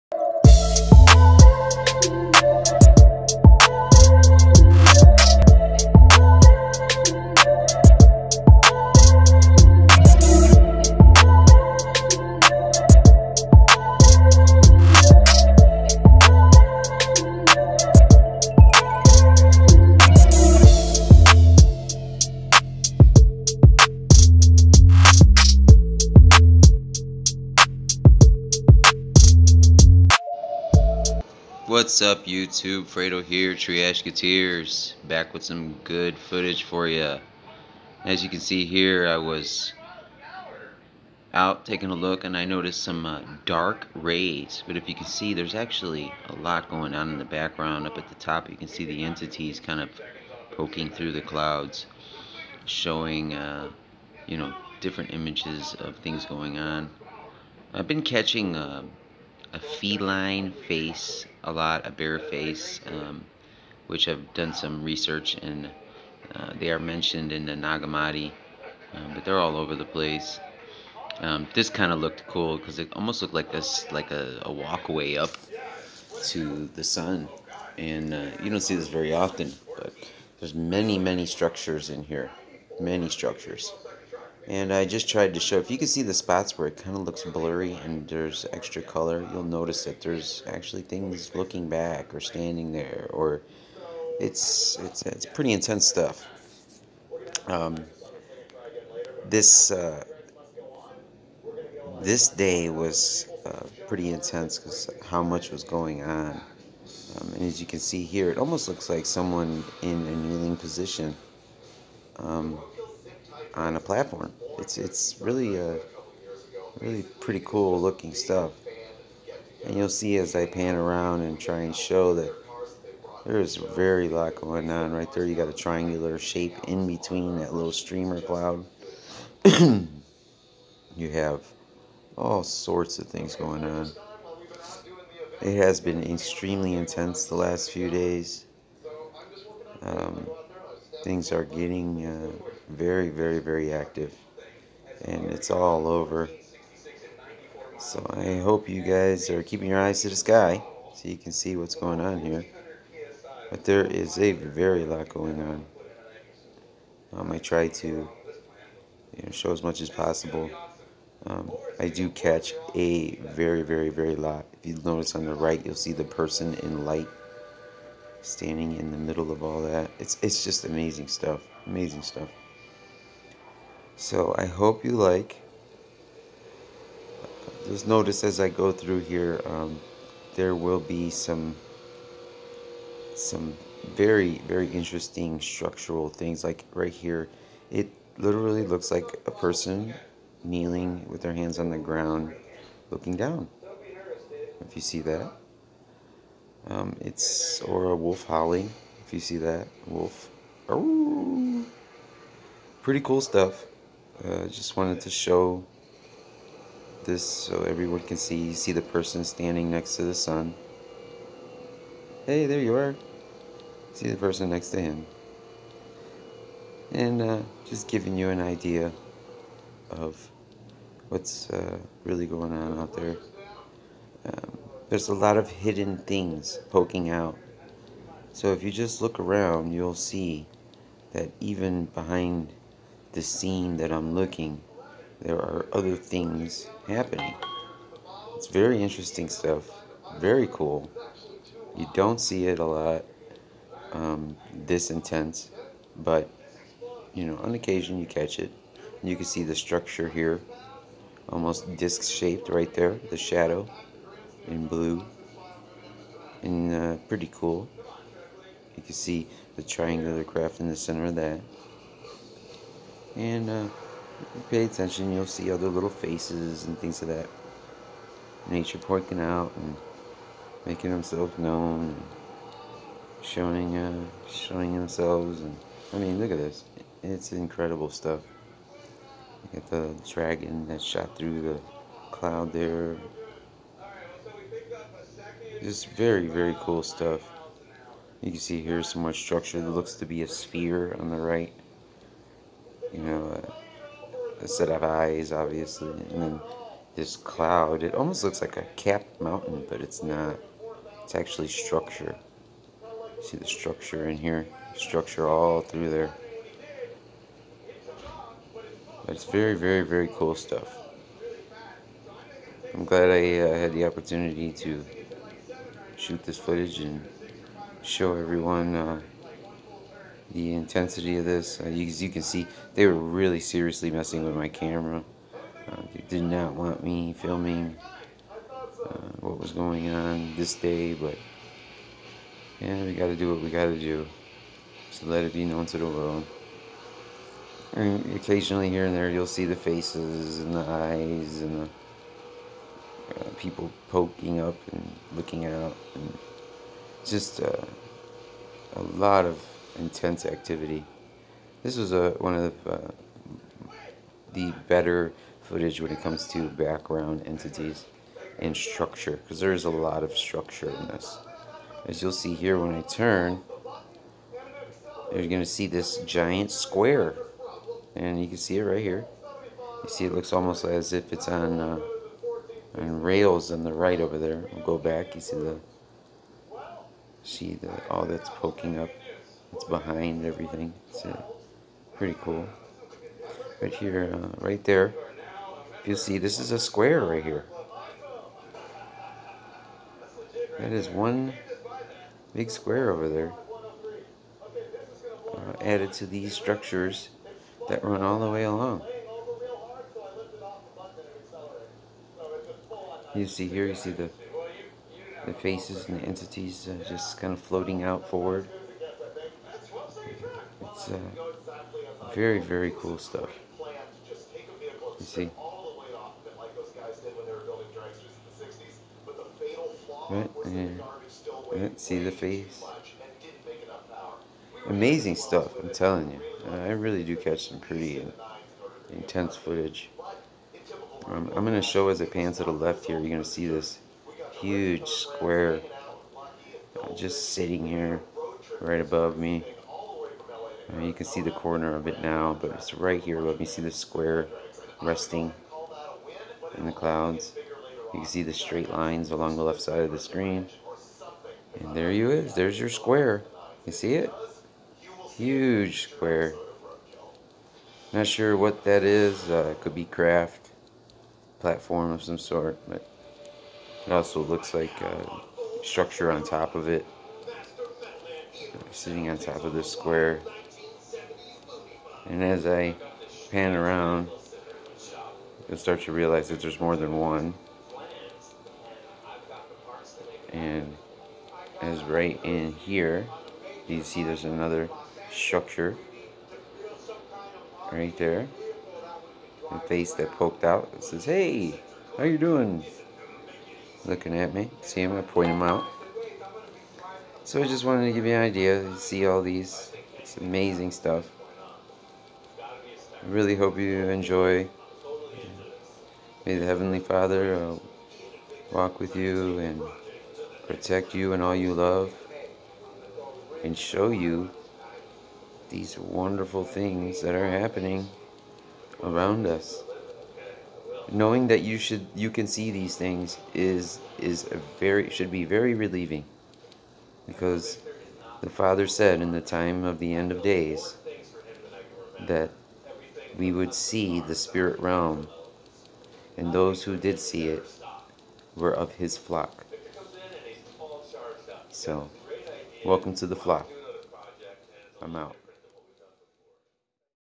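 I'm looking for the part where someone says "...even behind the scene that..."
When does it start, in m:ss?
3:51.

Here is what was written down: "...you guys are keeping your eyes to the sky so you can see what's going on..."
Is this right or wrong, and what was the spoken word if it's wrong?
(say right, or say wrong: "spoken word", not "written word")
right.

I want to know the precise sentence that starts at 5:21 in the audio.
Uh, you, as you can see, they were really seriously messing with my camera.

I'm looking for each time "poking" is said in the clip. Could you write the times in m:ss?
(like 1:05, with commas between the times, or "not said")
0:50, 3:46, 4:28, 5:43, 6:18.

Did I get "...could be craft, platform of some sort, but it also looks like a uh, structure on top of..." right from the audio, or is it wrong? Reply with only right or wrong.
right.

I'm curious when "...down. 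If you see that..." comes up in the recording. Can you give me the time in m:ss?
3:13.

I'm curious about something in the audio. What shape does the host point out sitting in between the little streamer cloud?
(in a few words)
Triangular shape.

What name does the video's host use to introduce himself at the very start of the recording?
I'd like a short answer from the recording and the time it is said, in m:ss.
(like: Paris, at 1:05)
Fredo, at 0:32.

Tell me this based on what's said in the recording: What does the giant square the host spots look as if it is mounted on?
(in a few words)
Rails.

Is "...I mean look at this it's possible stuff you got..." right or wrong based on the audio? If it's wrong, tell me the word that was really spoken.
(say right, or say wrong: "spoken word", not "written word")
wrong: "incredible", not "possible".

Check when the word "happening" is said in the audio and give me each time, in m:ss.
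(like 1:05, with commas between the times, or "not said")
3:56, 8:37.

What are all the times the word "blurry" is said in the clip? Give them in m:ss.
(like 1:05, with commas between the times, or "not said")
1:27.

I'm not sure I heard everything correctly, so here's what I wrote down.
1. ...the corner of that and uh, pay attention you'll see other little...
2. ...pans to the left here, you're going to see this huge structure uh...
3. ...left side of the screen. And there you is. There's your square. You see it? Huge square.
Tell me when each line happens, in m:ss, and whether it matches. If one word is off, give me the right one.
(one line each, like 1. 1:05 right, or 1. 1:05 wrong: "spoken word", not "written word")
1. 4:20 wrong: "center", not "corner"
2. 7:12 wrong: "square", not "structure"
3. 7:29 right.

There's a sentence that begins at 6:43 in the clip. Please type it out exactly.
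You see here, you see the the faces and the entities uh, just kind of floating out forward.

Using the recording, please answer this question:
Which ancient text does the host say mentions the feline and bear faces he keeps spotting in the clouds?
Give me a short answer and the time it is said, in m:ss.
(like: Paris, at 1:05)
Nag Hammadi, at 1:07.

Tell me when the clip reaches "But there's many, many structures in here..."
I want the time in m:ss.
1:19.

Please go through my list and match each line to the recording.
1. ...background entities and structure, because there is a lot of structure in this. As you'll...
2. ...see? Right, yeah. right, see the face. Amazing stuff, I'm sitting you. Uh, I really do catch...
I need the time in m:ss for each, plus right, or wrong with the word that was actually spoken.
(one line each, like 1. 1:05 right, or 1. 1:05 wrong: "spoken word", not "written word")
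1. 5:56 right
2. 6:55 wrong: "telling", not "sitting".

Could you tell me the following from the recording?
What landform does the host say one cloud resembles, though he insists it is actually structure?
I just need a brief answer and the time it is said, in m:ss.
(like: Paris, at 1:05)
Capped mountain, at 4:58.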